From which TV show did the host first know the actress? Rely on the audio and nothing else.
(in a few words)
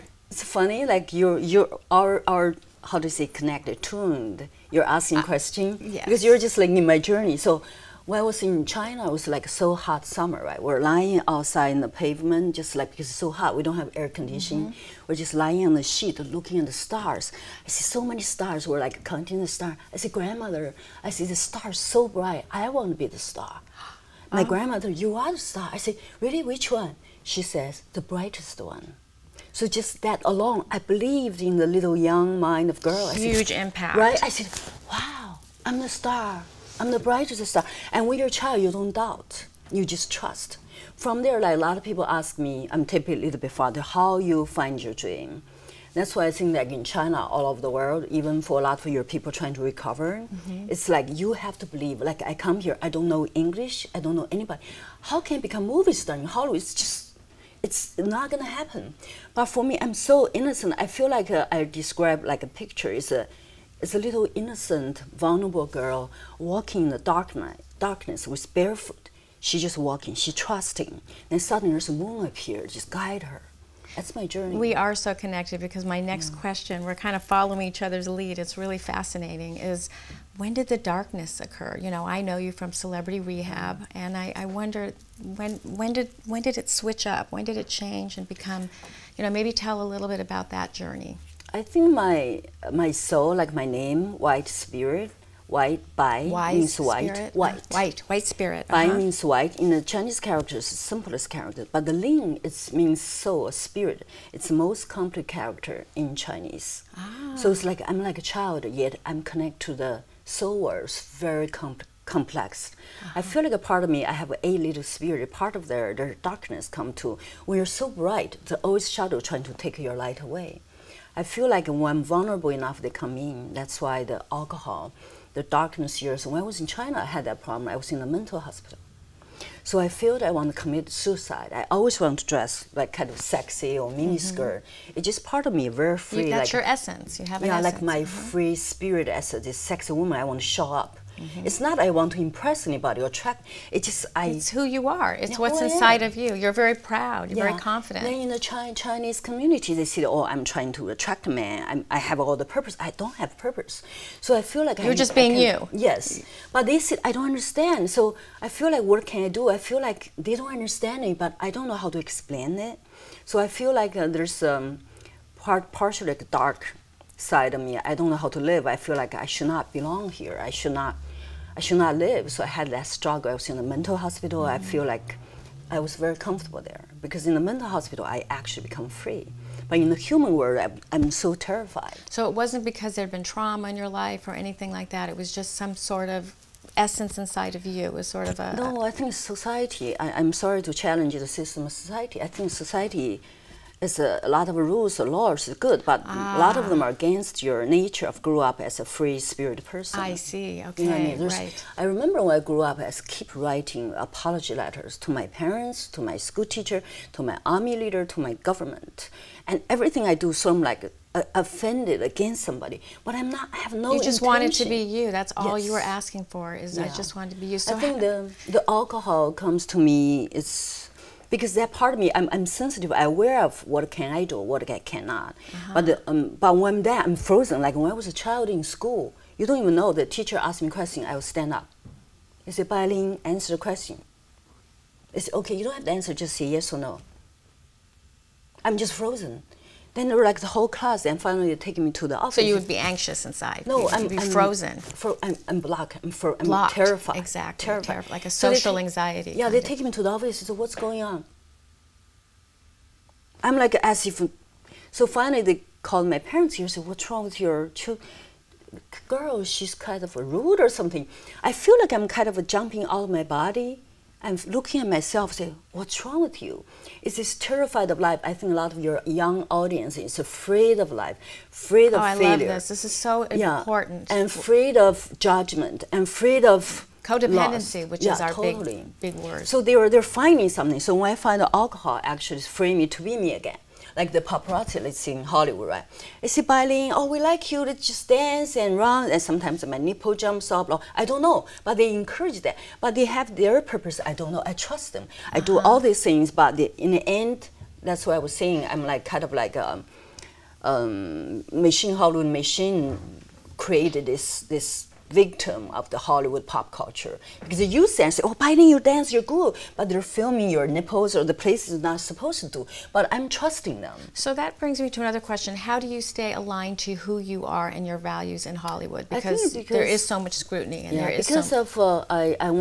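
Celebrity Rehab.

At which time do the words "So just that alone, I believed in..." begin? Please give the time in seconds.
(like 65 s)
29 s.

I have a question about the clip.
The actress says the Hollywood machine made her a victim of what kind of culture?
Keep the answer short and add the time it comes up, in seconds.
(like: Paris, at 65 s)
Hollywood pop culture, at 305 s.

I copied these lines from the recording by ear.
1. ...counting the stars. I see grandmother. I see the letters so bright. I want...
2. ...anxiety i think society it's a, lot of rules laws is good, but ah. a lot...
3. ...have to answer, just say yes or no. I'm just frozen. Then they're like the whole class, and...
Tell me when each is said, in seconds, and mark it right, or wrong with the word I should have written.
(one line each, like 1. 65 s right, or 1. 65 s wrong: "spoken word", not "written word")
1. 19 s wrong: "stars", not "letters"
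2. 191 s wrong: "society", not "anxiety"
3. 235 s right.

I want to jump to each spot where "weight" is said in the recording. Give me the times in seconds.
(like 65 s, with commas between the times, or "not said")
not said.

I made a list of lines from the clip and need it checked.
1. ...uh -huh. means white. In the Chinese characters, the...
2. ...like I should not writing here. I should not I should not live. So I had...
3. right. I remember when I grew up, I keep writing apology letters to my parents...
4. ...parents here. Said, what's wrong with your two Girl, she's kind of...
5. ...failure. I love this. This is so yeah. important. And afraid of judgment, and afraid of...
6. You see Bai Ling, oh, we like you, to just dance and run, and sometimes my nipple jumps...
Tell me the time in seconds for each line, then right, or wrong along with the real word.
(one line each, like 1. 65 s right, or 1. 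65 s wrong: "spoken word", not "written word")
1. 98 s right
2. 169 s wrong: "belong", not "writing"
3. 201 s right
4. 256 s right
5. 272 s right
6. 286 s right.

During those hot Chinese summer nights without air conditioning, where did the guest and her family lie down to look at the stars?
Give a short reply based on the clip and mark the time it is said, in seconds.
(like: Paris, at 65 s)
The pavement, at 11 s.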